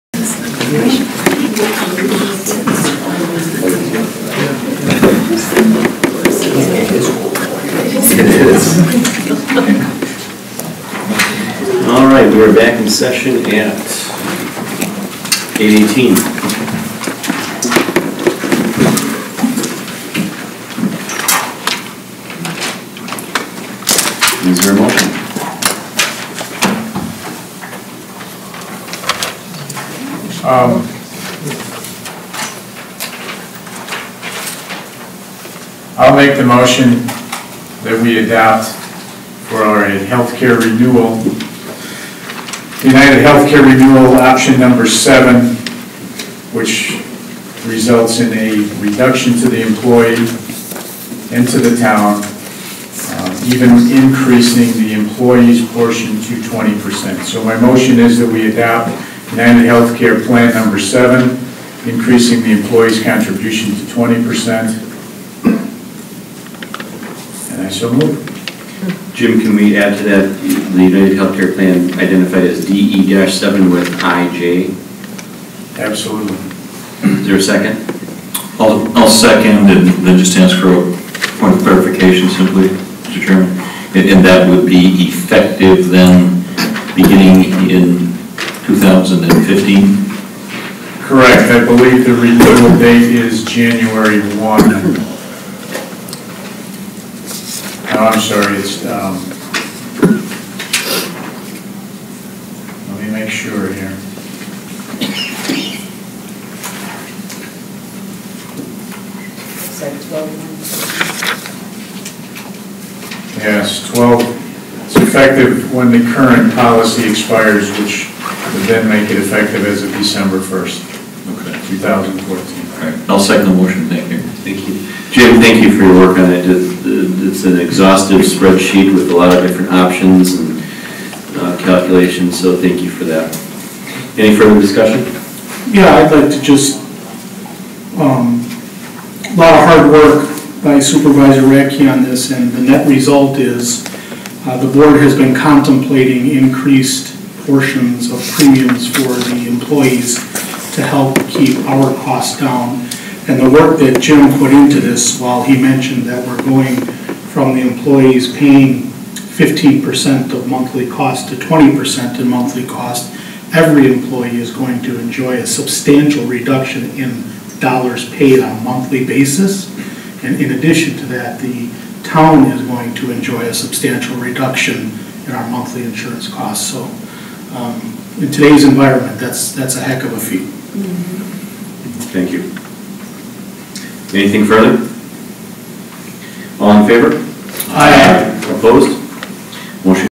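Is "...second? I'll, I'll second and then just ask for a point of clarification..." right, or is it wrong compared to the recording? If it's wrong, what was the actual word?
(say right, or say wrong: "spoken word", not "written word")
right.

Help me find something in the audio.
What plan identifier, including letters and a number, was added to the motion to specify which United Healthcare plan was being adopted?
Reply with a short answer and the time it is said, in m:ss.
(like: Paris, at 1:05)
DE-7, at 1:12.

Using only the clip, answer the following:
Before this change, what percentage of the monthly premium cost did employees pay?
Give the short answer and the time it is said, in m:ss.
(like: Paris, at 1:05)
15%, at 2:38.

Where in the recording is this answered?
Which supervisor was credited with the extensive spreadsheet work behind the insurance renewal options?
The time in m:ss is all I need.
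2:21.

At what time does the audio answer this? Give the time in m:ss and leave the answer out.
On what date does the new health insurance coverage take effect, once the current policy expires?
1:59.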